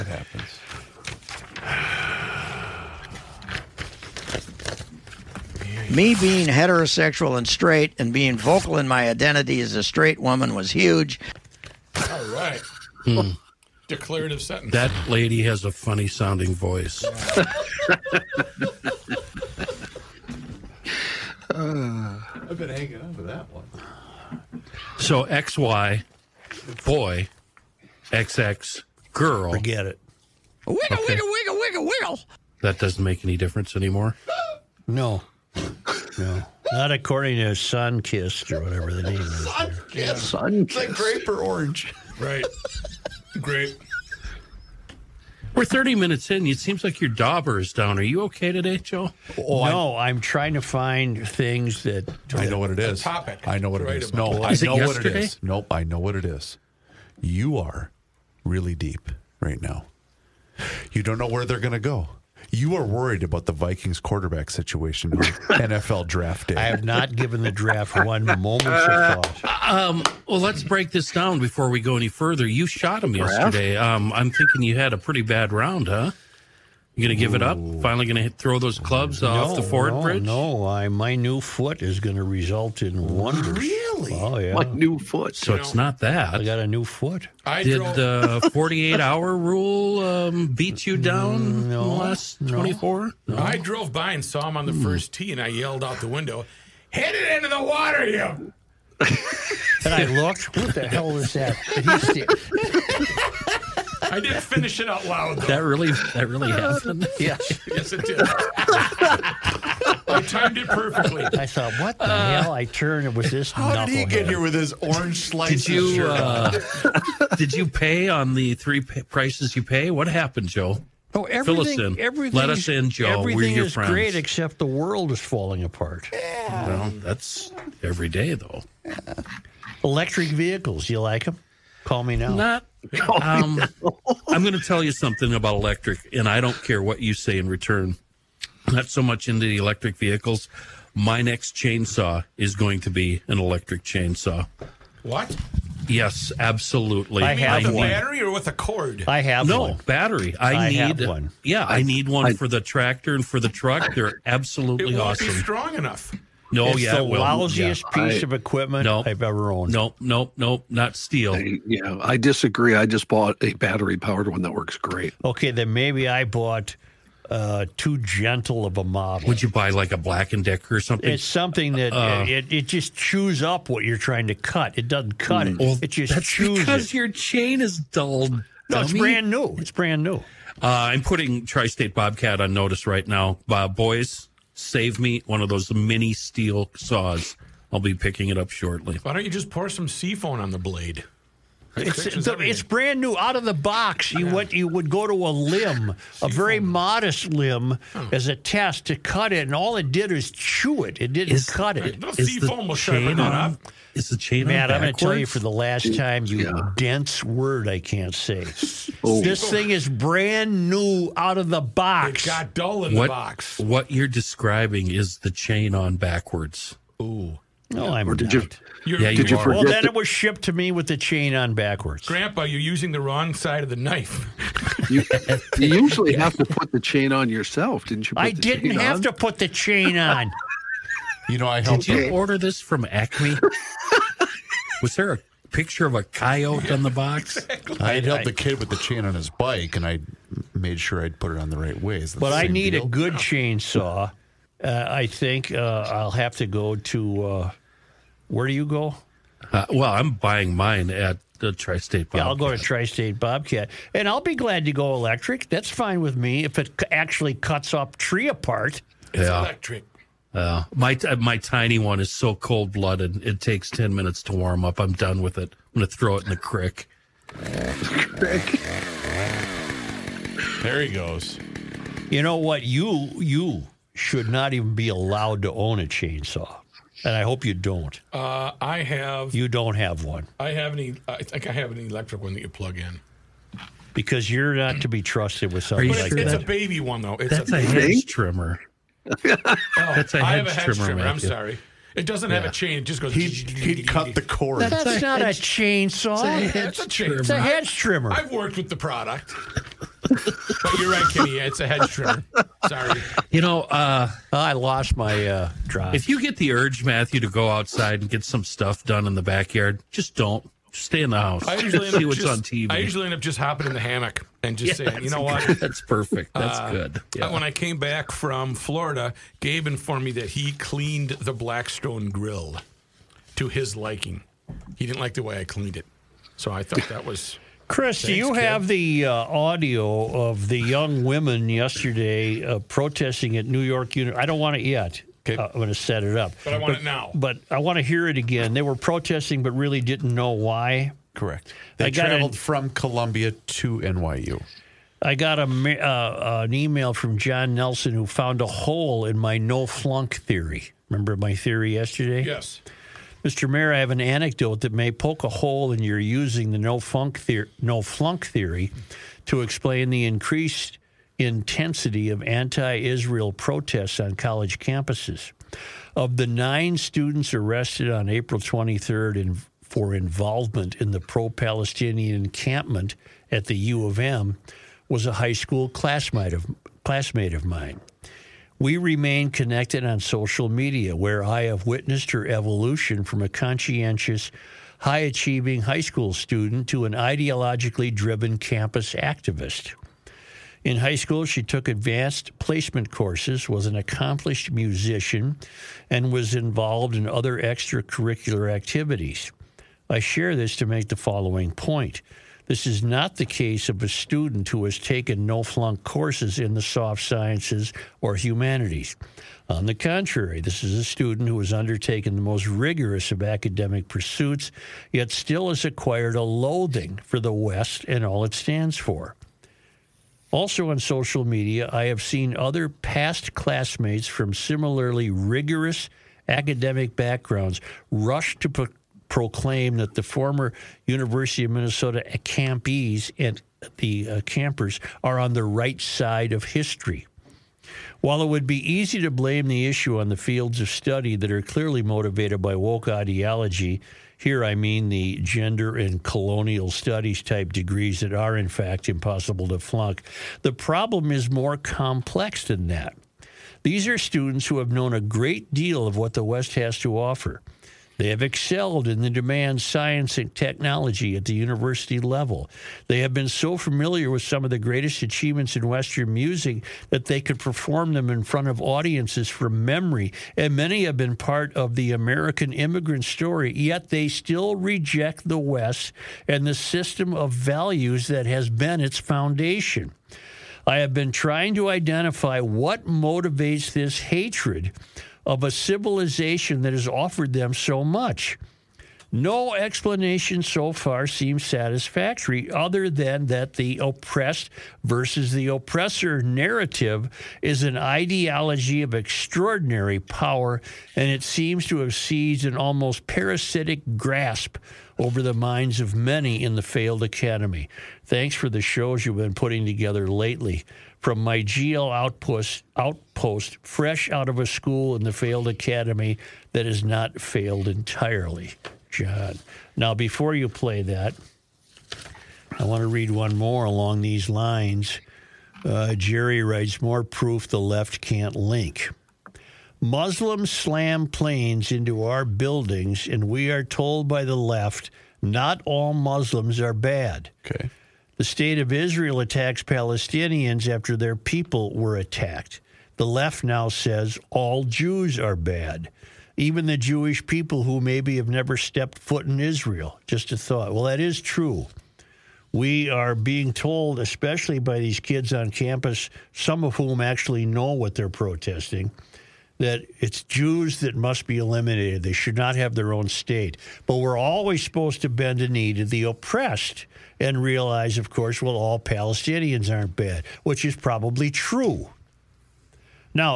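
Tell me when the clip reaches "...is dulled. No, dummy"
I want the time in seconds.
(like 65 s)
177 s.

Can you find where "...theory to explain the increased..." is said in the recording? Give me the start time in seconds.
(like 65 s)
358 s.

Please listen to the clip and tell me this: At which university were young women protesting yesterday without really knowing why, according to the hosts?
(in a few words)
New York University.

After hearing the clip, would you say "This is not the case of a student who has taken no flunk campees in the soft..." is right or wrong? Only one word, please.
wrong.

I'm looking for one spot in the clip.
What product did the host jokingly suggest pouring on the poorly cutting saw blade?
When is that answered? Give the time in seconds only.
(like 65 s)
189 s.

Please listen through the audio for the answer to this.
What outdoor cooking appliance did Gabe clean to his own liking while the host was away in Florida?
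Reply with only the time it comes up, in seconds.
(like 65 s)
321 s.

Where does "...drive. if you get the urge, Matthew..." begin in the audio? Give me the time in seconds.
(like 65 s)
305 s.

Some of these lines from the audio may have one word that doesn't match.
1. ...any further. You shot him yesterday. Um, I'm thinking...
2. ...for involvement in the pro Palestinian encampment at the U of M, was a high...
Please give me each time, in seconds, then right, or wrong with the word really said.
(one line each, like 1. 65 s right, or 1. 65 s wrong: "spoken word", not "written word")
1. 71 s right
2. 369 s right.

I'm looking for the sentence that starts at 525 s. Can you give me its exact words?
Uh, Jerry writes More proof the left can't link.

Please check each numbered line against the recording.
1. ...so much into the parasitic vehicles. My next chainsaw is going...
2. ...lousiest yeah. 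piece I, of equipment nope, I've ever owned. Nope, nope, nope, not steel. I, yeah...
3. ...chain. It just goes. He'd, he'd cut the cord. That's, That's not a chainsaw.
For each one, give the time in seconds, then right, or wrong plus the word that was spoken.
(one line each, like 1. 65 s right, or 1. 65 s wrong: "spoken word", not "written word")
1. 138 s wrong: "electric", not "parasitic"
2. 157 s right
3. 292 s right.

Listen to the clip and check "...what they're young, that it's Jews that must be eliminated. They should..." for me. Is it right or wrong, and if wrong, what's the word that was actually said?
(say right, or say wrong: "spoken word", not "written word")
wrong: "protesting", not "young".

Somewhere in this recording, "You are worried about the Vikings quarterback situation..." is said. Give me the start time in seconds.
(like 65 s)
62 s.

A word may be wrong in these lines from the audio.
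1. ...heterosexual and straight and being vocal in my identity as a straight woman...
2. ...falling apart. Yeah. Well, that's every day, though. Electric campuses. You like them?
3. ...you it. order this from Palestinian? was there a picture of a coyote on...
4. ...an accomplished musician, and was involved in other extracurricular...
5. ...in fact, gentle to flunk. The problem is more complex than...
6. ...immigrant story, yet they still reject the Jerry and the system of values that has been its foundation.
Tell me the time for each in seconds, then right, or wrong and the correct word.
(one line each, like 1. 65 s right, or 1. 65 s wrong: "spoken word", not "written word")
1. 6 s right
2. 125 s wrong: "vehicles", not "campuses"
3. 231 s wrong: "Acme", not "Palestinian"
4. 393 s right
5. 448 s wrong: "impossible", not "gentle"
6. 472 s wrong: "West", not "Jerry".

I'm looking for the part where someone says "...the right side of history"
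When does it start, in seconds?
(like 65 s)
435 s.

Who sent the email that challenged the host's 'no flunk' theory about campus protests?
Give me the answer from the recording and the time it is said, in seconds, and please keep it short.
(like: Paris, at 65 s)
John Nelson, at 347 s.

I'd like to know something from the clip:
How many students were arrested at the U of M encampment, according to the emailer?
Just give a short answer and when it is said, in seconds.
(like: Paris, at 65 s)
9, at 366 s.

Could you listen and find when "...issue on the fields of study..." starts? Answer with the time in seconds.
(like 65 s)
439 s.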